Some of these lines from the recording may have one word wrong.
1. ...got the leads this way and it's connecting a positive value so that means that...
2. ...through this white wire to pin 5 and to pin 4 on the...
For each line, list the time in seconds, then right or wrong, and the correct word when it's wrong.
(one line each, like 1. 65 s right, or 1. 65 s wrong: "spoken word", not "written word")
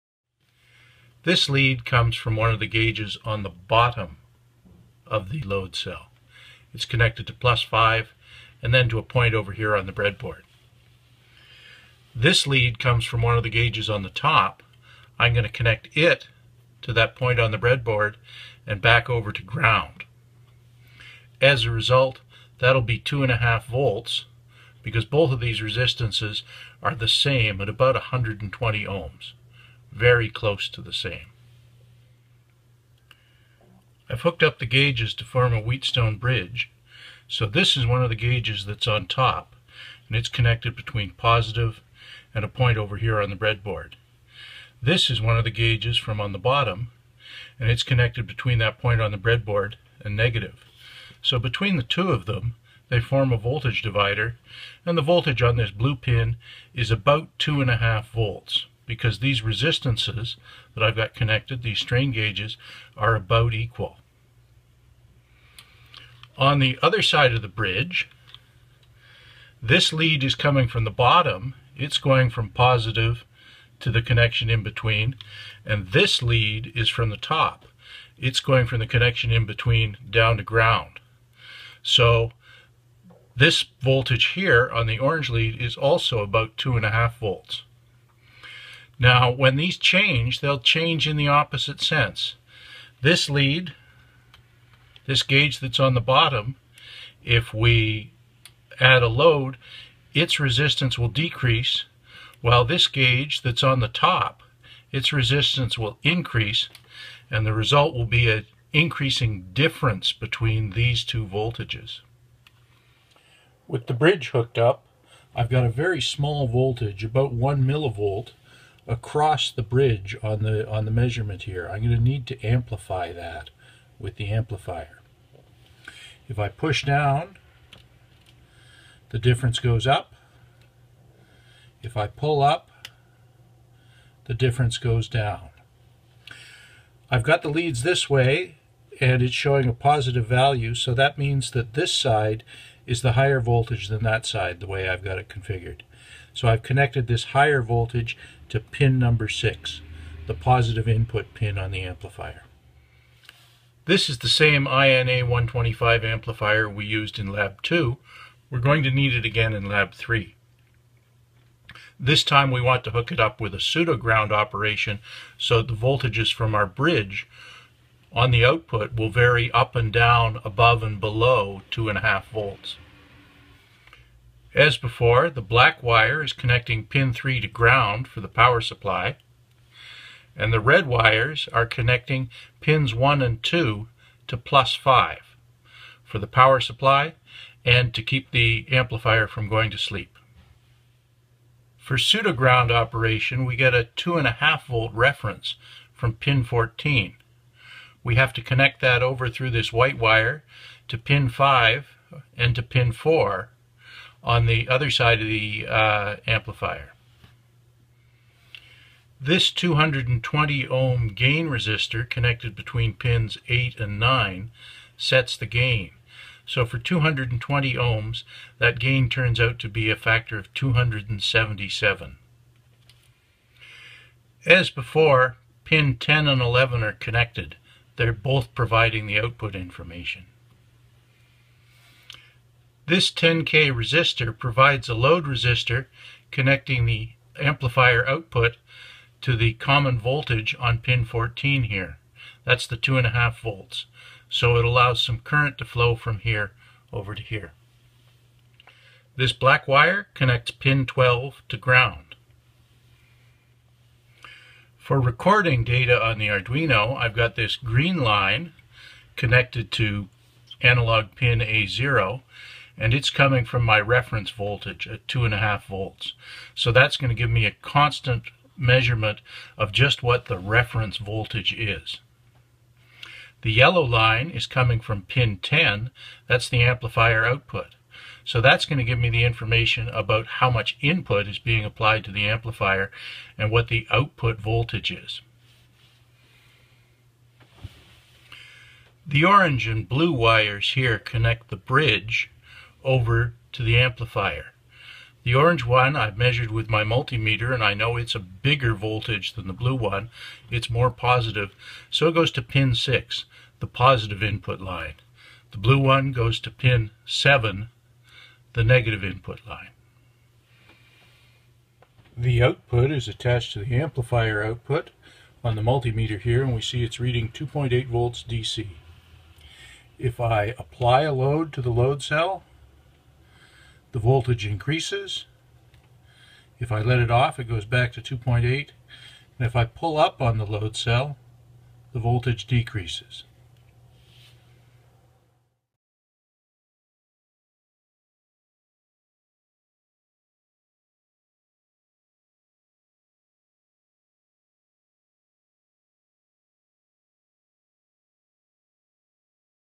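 1. 137 s wrong: "showing", not "connecting"
2. 199 s right.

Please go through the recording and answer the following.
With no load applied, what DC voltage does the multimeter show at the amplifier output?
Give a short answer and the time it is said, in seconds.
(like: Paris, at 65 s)
2.8 volts, at 317 s.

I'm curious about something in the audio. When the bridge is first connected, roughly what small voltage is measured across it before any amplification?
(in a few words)
1 millivolt.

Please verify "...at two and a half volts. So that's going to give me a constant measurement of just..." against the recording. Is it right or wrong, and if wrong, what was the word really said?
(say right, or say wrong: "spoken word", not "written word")
right.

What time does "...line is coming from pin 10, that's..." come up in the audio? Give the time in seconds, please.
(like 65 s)
273 s.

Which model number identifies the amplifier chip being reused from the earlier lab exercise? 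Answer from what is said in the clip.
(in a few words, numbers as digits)
INA125.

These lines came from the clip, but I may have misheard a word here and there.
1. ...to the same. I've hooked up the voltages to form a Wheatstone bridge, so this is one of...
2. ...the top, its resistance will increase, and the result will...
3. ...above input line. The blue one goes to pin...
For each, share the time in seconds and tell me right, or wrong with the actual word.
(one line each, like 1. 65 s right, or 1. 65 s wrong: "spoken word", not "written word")
1. 30 s wrong: "gauges", not "voltages"
2. 103 s right
3. 303 s wrong: "positive", not "above".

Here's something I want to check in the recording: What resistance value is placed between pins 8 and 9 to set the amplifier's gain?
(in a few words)
220 ohms.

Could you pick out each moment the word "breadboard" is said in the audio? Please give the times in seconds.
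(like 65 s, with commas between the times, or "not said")
9 s, 17 s, 43 s, 49 s.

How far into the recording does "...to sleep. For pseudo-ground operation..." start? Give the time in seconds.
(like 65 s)
189 s.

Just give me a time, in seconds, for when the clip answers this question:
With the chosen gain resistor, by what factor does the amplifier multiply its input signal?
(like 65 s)
220 s.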